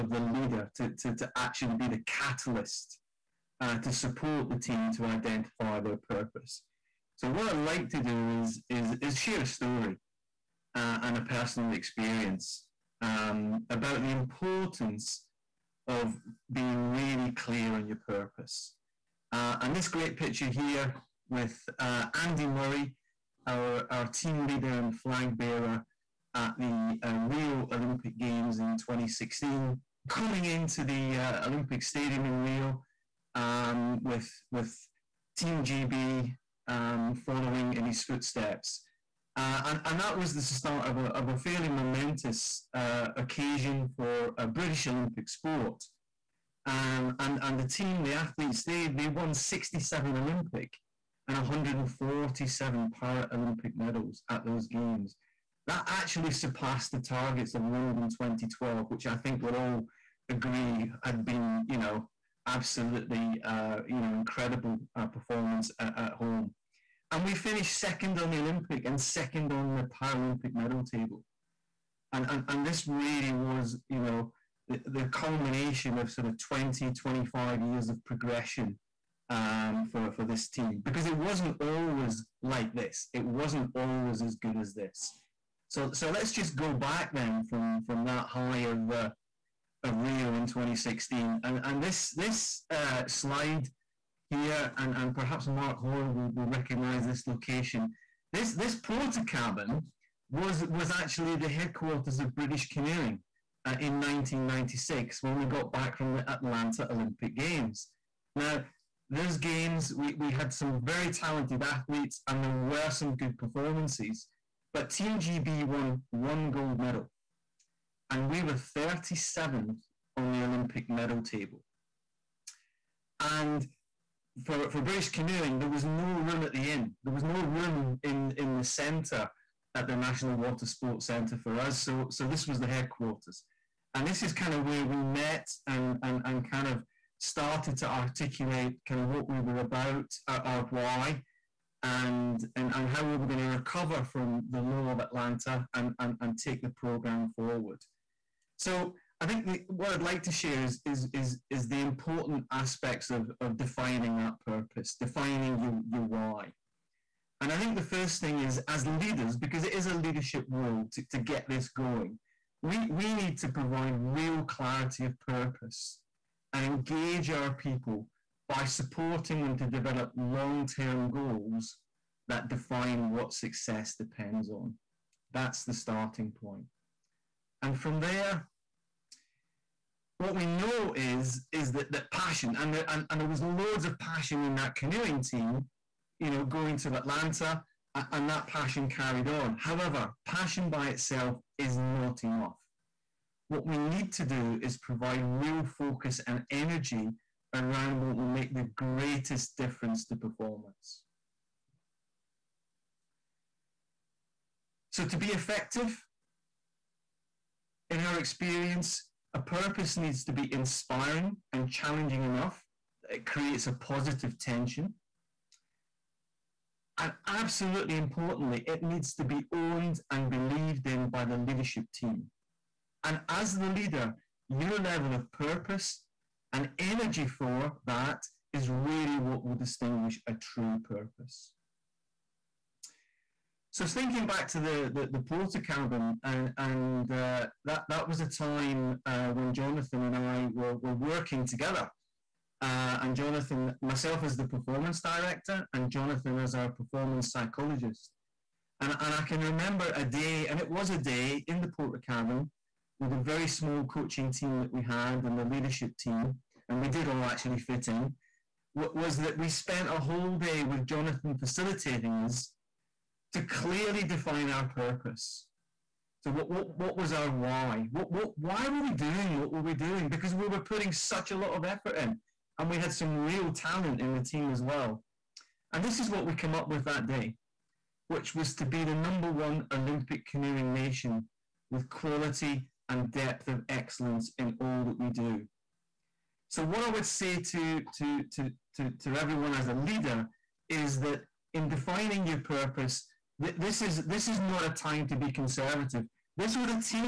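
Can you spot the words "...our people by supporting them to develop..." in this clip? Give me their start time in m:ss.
2:47.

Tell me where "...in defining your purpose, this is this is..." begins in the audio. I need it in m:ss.
4:51.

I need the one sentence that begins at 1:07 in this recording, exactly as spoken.
And we finished second on the Olympic and second on the Paralympic medal table.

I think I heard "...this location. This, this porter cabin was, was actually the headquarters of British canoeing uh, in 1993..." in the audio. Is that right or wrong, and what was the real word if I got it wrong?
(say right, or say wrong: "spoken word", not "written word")
wrong: "1996", not "1993".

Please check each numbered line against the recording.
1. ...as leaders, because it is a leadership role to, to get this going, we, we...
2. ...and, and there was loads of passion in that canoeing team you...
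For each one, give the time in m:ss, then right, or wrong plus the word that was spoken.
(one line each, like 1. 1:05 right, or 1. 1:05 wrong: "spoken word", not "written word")
1. 2:38 right
2. 3:02 right.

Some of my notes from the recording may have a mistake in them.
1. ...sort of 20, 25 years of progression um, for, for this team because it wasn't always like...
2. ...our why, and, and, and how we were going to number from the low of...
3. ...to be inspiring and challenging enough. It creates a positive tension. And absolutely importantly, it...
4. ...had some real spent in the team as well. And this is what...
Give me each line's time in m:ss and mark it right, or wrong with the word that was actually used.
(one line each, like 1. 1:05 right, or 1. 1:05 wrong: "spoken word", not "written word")
1. 1:16 right
2. 2:20 wrong: "recover", not "number"
3. 3:30 right
4. 4:32 wrong: "talent", not "spent".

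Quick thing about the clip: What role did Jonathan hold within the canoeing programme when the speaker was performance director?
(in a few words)
performance psychologist.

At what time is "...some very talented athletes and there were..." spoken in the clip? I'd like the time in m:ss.
1:50.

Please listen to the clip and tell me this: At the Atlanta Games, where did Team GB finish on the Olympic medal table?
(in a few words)
37th.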